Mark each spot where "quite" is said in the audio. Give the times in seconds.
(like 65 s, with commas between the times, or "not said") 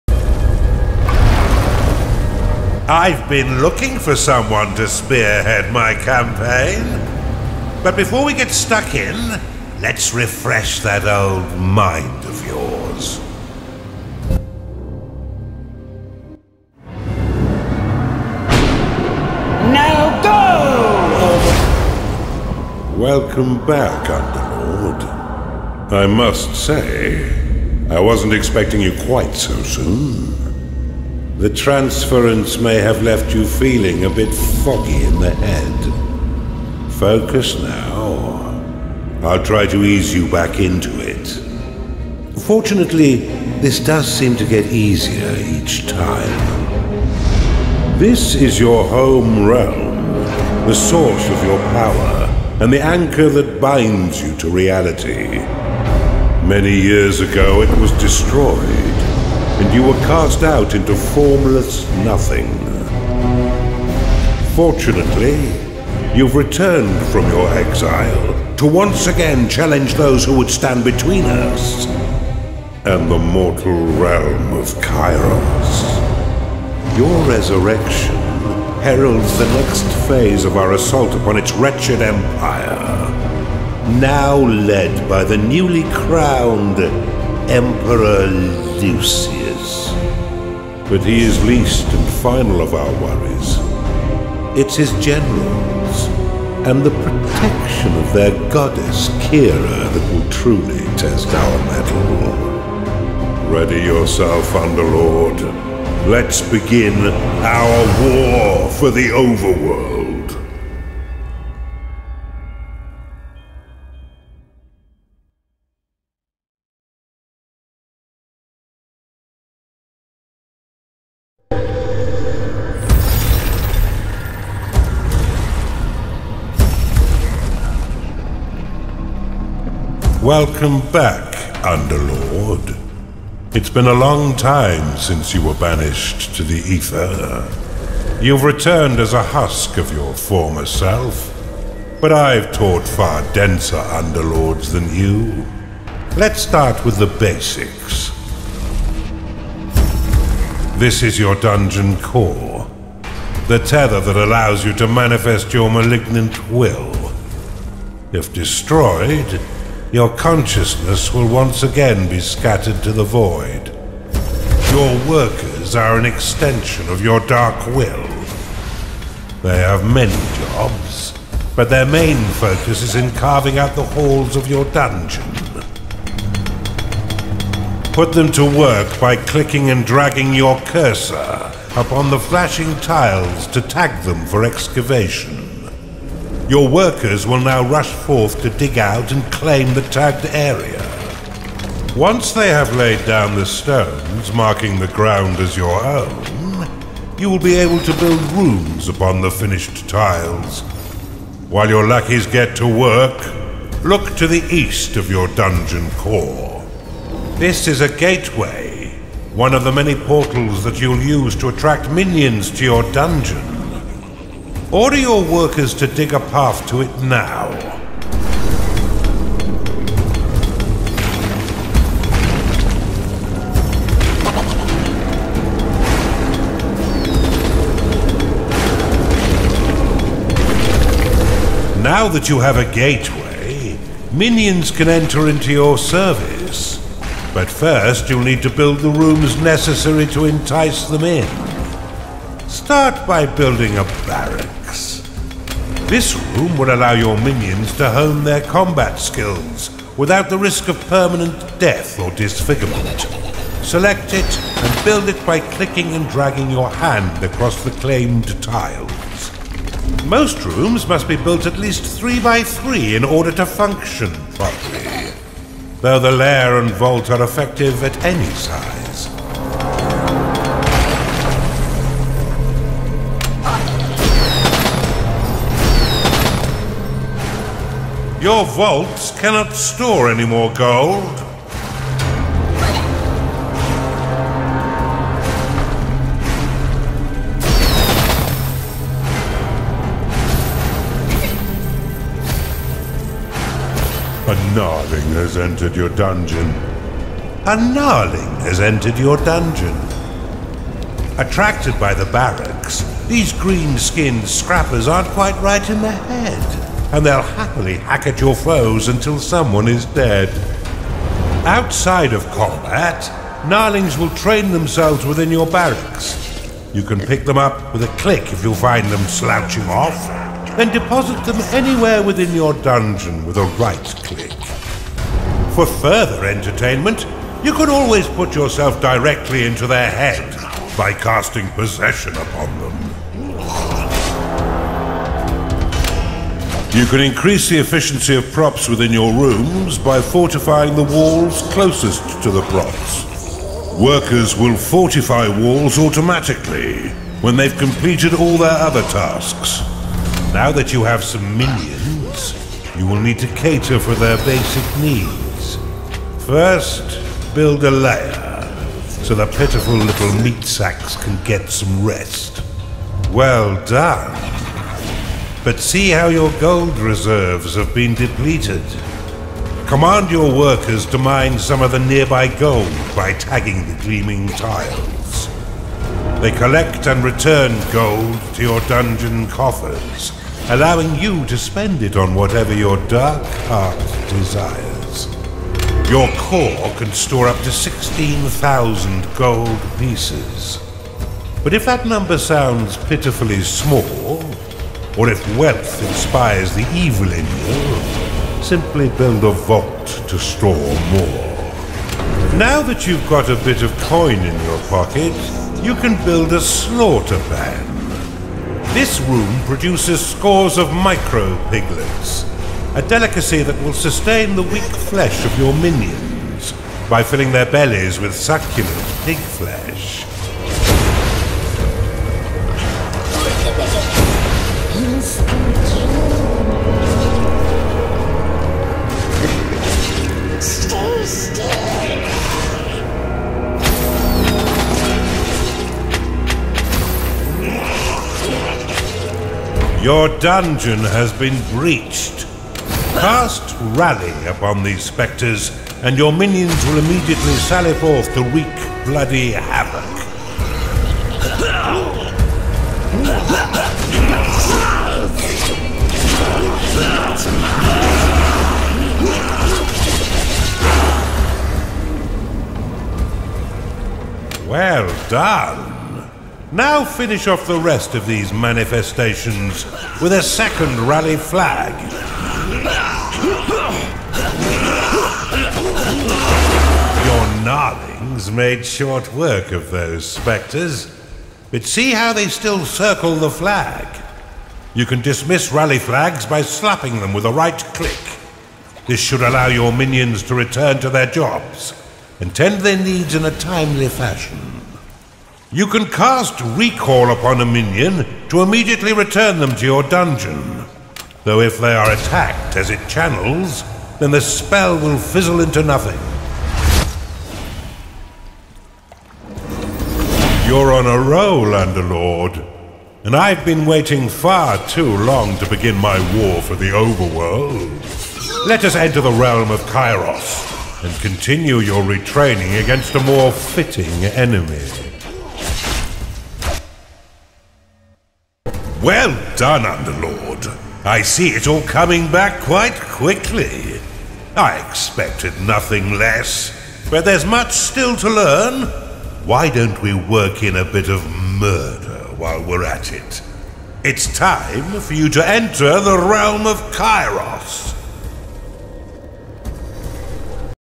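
29 s, 305 s, 532 s.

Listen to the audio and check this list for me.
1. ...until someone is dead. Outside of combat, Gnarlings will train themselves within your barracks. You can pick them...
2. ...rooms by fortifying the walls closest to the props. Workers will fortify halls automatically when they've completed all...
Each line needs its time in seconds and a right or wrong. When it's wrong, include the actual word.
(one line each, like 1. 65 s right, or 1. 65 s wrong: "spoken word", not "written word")
1. 308 s right
2. 339 s wrong: "walls", not "halls".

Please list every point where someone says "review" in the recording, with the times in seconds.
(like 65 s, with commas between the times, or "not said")
not said.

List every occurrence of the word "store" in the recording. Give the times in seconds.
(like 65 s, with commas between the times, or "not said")
279 s, 386 s, 400 s.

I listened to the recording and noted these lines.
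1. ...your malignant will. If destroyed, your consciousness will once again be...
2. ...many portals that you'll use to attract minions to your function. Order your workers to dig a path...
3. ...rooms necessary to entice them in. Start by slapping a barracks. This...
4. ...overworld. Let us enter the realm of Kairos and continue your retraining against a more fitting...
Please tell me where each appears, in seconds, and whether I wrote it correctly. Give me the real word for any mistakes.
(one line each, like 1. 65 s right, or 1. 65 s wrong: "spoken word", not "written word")
1. 155 s right
2. 209 s wrong: "dungeon", not "function"
3. 238 s wrong: "building", not "slapping"
4. 516 s right.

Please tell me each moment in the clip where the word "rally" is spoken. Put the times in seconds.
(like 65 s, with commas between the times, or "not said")
443 s, 470 s, 485 s.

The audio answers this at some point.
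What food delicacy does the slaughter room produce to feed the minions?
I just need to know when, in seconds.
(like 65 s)
410 s.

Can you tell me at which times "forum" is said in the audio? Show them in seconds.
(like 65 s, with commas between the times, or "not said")
not said.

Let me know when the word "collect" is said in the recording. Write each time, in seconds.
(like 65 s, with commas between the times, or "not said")
376 s.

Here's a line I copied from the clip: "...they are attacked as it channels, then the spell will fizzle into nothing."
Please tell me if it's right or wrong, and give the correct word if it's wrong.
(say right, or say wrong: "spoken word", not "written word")
right.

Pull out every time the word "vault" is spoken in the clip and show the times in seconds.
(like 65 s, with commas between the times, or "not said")
266 s, 278 s, 399 s.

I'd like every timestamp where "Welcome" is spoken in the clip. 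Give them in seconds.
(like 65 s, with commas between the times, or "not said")
23 s, 130 s.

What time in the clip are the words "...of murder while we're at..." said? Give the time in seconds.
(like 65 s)
540 s.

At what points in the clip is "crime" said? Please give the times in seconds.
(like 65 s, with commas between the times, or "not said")
not said.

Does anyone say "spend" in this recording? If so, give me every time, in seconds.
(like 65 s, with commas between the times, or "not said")
381 s.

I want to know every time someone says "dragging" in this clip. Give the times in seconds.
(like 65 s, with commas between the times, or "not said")
179 s, 256 s.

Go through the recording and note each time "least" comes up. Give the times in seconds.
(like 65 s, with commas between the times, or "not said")
91 s, 261 s.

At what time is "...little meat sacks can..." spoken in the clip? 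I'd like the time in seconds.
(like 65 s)
359 s.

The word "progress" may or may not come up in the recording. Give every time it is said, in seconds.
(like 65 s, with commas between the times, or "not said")
not said.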